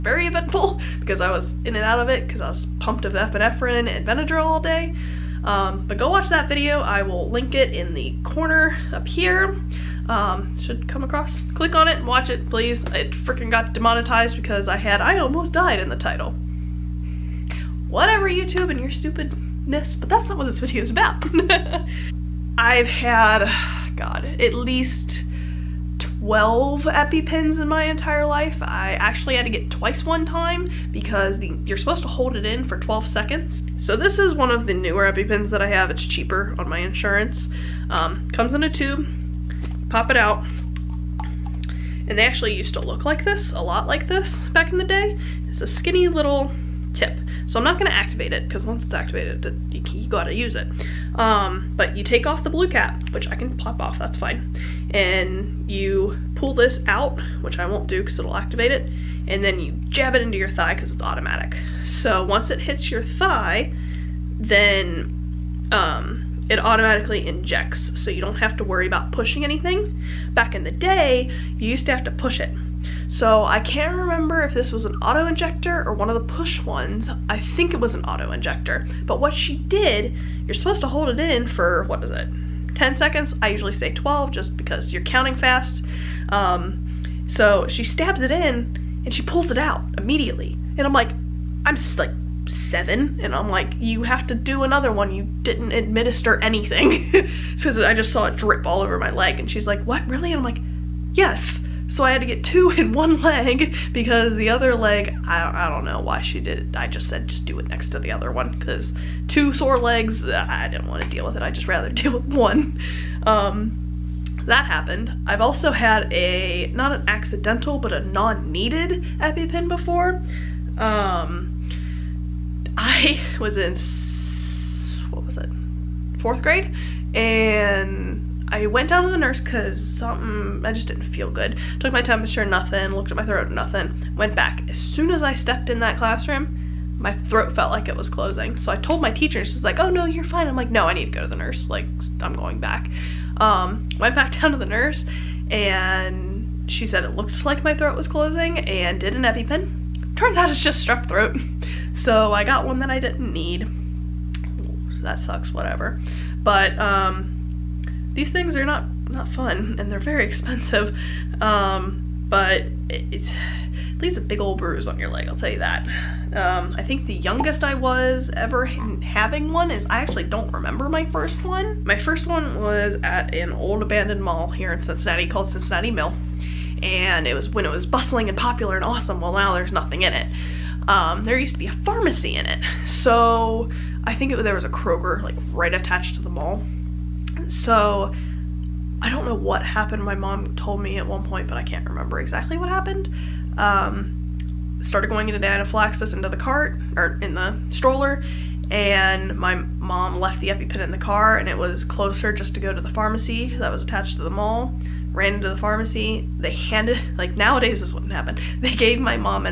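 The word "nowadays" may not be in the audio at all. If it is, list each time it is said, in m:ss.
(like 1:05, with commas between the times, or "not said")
3:27.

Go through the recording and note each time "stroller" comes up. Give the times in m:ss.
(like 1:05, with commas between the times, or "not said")
3:17.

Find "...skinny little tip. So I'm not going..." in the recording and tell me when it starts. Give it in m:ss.
0:45.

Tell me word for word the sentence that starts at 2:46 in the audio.
Um, I think the youngest I was ever having one is, I actually don't remember my first one.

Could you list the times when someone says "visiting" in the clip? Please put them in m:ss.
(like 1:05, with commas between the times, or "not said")
not said.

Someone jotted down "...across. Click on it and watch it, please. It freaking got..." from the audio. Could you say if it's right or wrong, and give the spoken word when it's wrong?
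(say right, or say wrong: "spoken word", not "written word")
right.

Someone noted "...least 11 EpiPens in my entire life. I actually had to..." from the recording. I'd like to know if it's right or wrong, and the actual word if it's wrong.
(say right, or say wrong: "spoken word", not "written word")
wrong: "12", not "11".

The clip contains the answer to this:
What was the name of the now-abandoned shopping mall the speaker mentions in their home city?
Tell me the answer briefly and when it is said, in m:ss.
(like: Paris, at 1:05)
Cincinnati Mill, at 2:55.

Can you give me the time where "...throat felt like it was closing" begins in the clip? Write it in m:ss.
2:17.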